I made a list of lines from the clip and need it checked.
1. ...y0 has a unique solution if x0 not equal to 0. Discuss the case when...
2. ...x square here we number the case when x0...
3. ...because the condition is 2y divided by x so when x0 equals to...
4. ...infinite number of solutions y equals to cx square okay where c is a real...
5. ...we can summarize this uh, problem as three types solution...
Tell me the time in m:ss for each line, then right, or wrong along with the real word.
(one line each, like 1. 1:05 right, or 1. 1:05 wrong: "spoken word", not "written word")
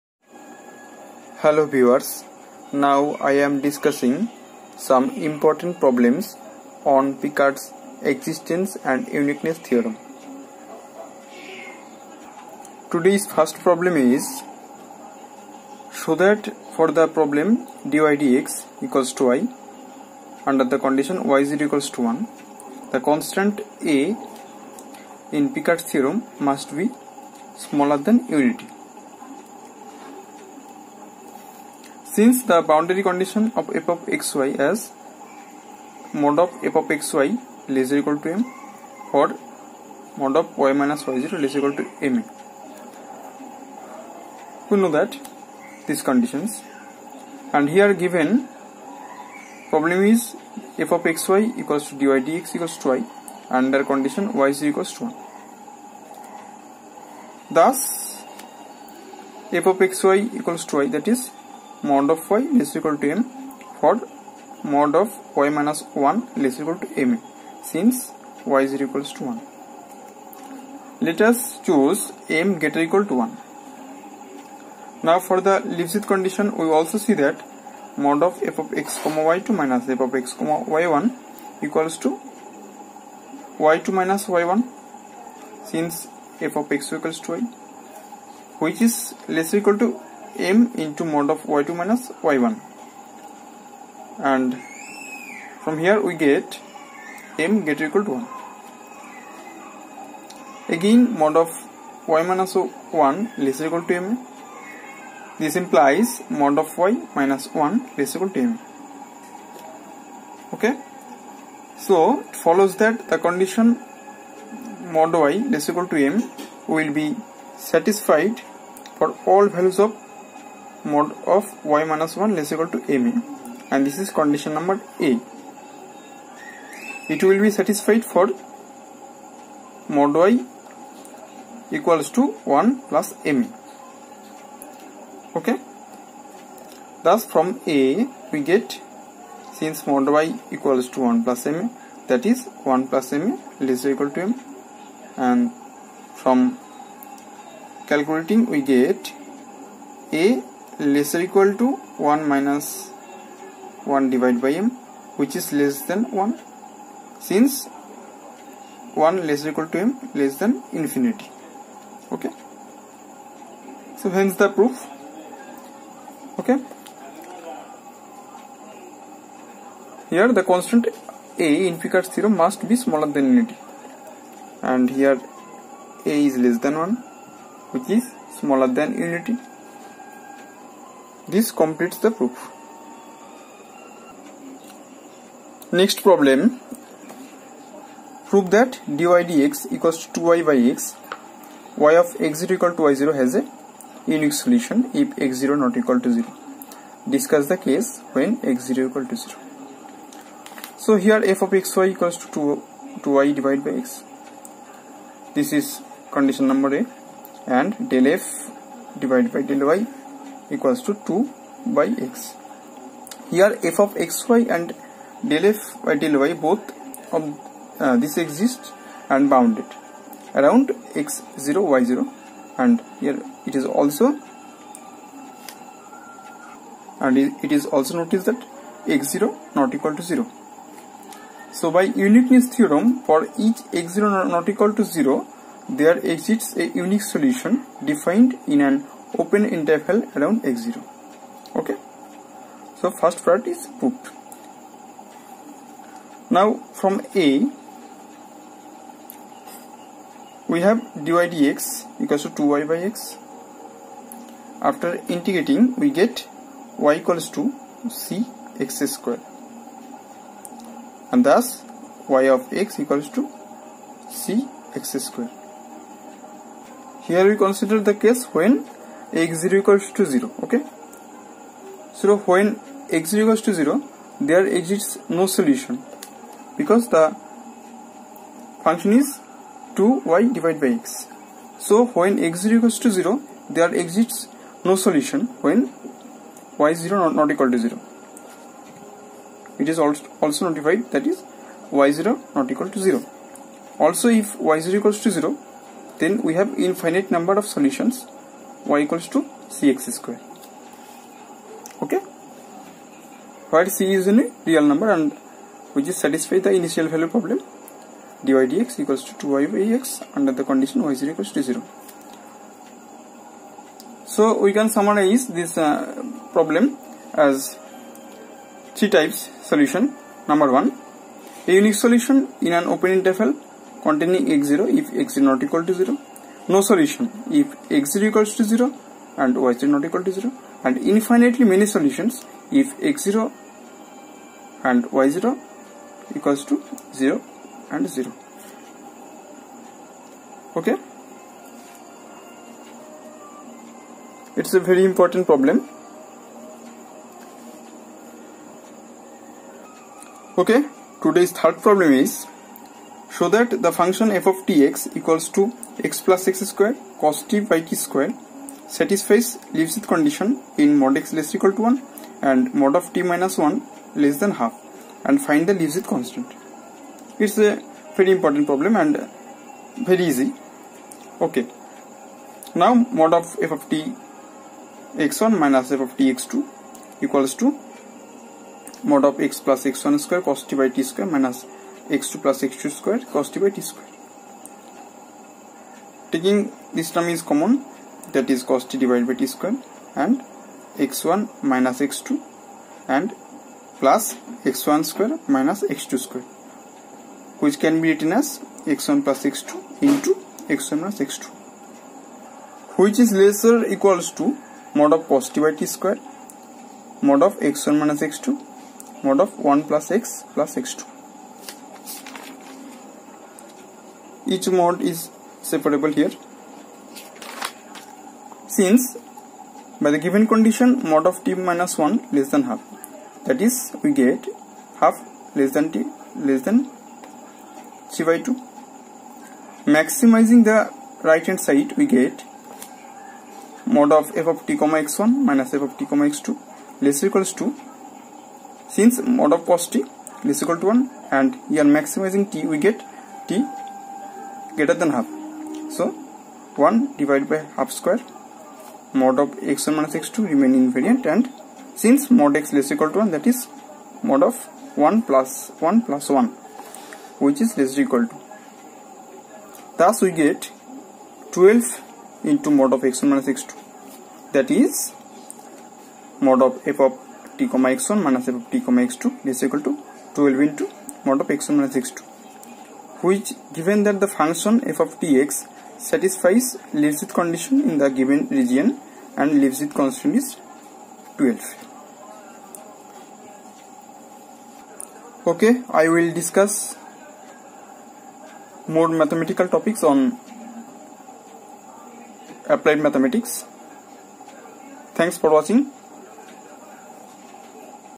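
1. 3:12 right
2. 4:24 wrong: "consider", not "number"
3. 4:36 wrong: "function", not "condition"
4. 4:56 right
5. 5:14 right.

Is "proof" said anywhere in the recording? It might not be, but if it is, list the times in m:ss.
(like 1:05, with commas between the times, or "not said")
2:44, 3:02.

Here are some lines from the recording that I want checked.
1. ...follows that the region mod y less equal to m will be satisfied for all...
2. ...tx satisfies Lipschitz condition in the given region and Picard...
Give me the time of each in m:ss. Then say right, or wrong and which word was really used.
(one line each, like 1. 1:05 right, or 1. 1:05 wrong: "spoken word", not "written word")
1. 1:52 wrong: "condition", not "region"
2. 7:55 wrong: "Lipschitz", not "Picard".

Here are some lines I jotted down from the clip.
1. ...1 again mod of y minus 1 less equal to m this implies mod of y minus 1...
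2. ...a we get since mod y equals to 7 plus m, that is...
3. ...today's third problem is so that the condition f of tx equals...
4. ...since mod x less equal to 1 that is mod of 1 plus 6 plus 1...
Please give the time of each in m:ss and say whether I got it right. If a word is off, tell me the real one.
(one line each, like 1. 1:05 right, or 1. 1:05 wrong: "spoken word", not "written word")
1. 1:38 right
2. 2:17 wrong: "1", not "7"
3. 5:51 wrong: "function", not "condition"
4. 7:31 wrong: "1", not "6".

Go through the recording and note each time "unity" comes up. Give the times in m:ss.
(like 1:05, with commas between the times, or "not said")
0:28, 2:53, 2:59.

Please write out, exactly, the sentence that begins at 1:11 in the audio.
Let us choose m greater equal to 1.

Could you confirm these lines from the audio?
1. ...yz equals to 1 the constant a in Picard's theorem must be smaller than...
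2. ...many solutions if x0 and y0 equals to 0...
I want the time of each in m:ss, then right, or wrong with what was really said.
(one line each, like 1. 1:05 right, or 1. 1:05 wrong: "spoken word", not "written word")
1. 0:21 right
2. 5:31 right.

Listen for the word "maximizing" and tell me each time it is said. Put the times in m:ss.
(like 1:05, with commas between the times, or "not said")
7:09, 7:21.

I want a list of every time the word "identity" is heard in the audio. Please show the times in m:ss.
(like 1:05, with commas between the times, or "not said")
not said.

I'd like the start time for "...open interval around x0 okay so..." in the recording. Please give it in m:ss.
3:59.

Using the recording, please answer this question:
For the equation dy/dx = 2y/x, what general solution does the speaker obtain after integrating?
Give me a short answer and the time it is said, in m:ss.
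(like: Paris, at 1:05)
y = cx², at 4:16.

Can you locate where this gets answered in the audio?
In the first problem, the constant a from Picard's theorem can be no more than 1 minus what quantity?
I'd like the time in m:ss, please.
2:33.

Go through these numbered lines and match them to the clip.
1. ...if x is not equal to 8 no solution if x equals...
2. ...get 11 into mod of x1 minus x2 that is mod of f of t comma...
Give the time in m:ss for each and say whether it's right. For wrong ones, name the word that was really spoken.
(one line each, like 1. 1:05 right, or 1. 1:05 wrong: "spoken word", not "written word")
1. 5:24 wrong: "0", not "8"
2. 7:40 wrong: "12", not "11".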